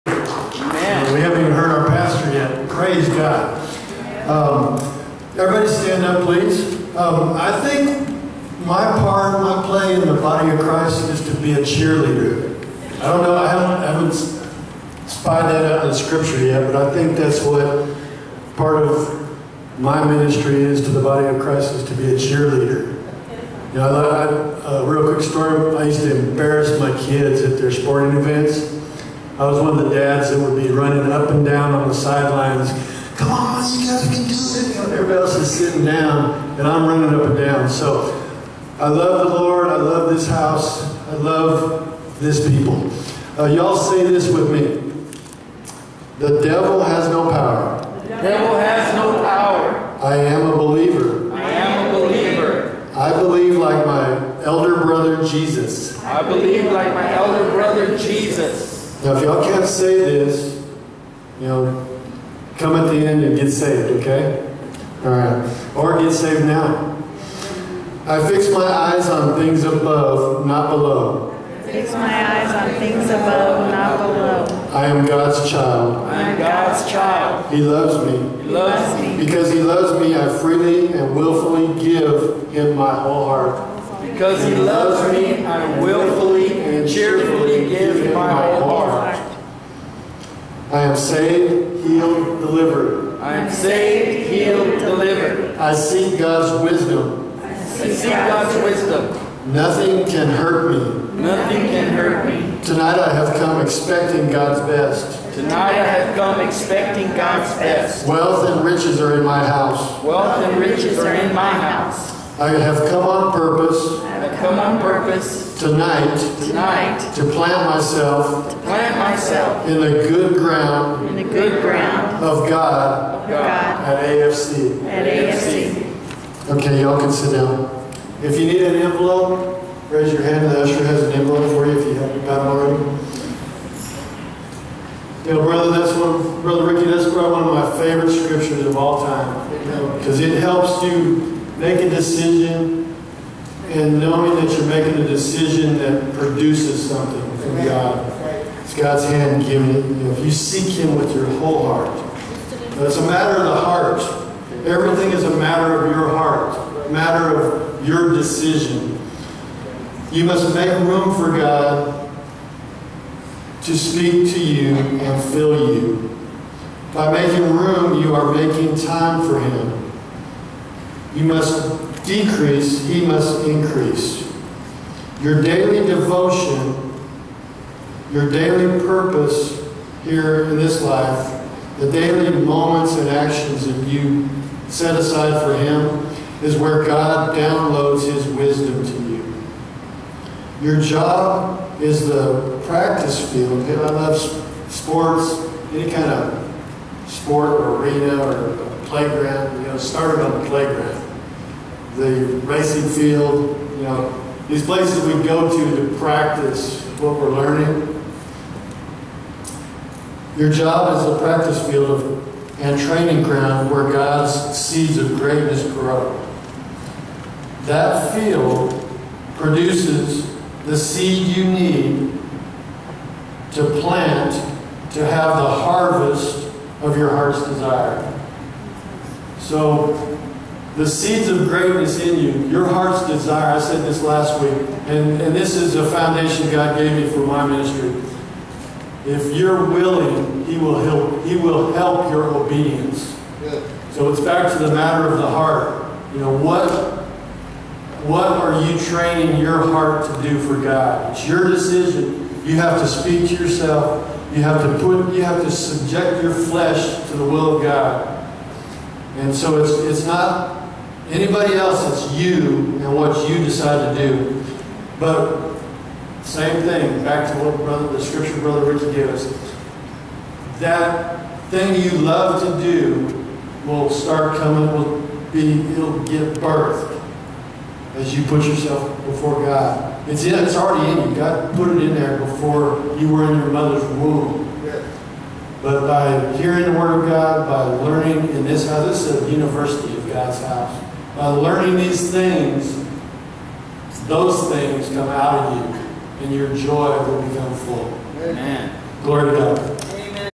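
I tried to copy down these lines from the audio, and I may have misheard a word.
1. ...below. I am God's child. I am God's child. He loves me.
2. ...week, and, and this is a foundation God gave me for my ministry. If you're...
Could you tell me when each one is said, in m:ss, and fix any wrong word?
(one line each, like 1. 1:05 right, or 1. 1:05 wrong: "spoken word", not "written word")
1. 1:13 right
2. 3:54 right.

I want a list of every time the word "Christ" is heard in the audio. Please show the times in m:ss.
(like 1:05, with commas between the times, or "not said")
0:10, 0:21.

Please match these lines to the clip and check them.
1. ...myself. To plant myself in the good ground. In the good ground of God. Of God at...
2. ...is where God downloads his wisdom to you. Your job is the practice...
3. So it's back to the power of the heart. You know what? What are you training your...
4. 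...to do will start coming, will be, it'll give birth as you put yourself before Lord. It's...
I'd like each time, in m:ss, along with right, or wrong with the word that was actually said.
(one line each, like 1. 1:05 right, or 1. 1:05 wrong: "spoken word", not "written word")
1. 1:57 right
2. 3:06 right
3. 4:03 wrong: "matter", not "power"
4. 4:32 wrong: "God", not "Lord".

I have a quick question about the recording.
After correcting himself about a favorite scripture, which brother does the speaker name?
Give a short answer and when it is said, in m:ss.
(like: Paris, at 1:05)
Brother Ricky, at 2:16.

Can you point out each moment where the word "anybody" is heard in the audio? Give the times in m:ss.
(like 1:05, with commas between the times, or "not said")
4:21.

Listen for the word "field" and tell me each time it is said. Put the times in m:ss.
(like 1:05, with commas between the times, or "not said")
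3:13, 3:22, 3:31, 3:38.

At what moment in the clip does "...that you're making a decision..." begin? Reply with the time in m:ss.
2:24.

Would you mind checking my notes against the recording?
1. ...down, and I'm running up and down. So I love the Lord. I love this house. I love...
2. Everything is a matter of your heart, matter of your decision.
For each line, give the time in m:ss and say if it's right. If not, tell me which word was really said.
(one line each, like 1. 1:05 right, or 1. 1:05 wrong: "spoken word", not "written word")
1. 0:35 right
2. 2:34 right.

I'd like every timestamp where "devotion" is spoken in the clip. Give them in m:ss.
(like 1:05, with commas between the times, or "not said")
2:55.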